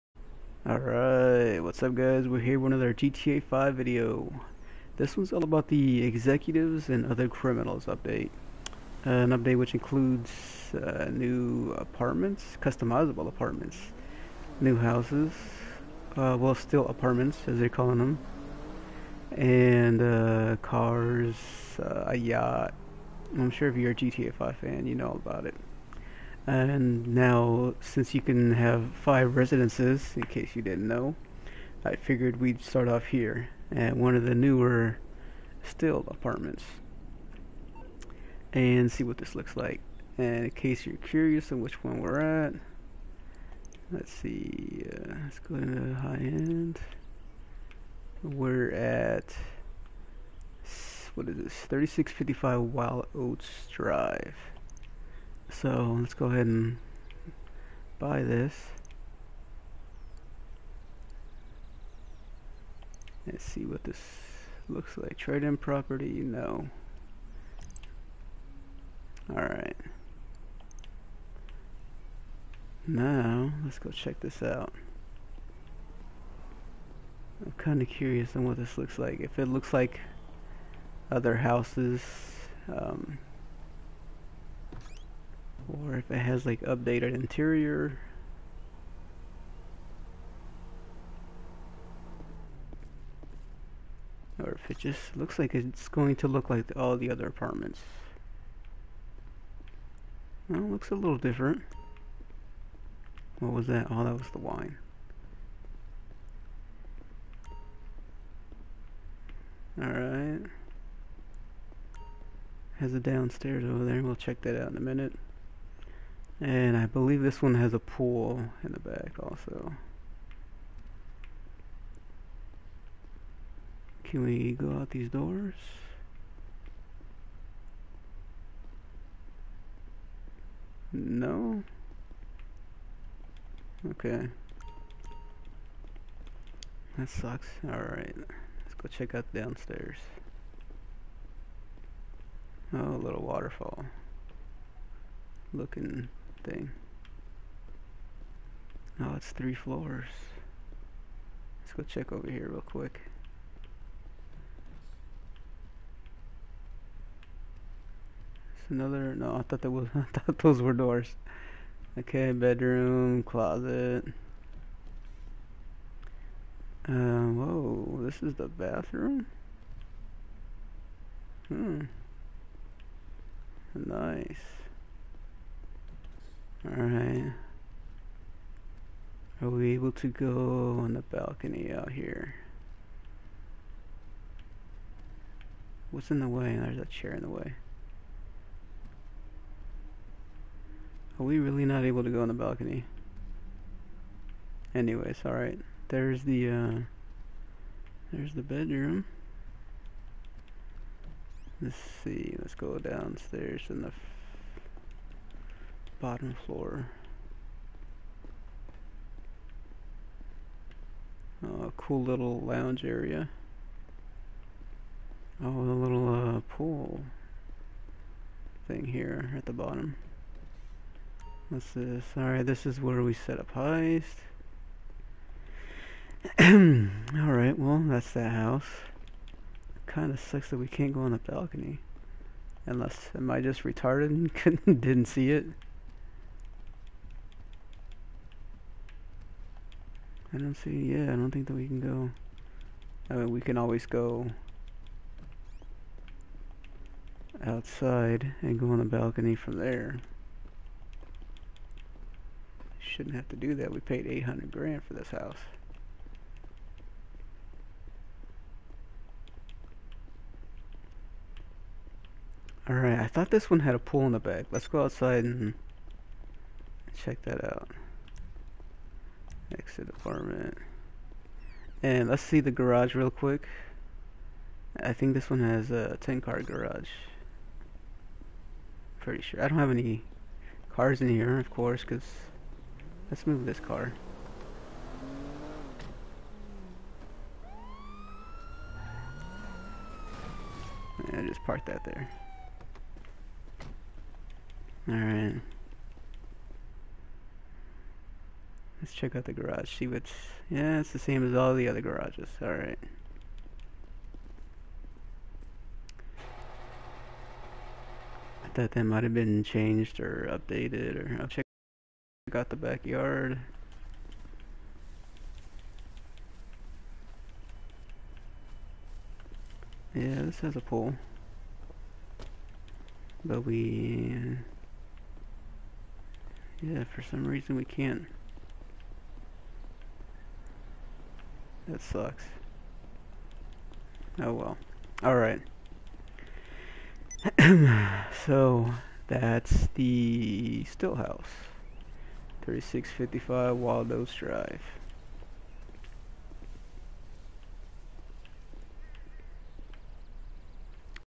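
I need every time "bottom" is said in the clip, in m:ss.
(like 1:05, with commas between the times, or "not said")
3:26, 3:39.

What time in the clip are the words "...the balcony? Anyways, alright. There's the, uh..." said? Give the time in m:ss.
3:12.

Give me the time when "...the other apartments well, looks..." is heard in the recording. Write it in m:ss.
1:36.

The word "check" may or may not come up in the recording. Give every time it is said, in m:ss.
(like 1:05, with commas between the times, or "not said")
1:13, 1:54, 2:18, 2:31, 4:26, 4:58, 5:11.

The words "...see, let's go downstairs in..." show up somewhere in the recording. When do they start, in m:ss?
3:22.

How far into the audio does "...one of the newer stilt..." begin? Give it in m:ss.
0:33.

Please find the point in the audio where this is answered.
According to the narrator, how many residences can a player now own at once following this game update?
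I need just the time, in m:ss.
0:28.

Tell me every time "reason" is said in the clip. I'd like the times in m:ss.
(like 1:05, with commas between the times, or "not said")
5:27.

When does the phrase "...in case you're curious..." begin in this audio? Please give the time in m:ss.
0:40.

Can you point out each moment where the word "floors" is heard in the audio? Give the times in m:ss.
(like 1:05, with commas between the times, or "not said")
2:29, 3:26.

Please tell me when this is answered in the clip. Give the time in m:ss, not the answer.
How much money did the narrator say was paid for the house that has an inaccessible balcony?
4:14.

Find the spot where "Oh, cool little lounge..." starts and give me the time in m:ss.
3:31.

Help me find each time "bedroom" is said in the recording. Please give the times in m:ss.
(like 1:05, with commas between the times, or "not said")
2:42, 3:18.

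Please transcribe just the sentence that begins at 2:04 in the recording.
Can we go out these doors?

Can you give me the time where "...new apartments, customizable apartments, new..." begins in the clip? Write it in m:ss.
0:11.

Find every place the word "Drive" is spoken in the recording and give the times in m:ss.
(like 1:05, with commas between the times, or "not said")
0:53, 5:44.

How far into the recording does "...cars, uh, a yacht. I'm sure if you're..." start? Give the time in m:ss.
0:20.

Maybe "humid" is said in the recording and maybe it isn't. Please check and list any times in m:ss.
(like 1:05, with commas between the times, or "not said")
not said.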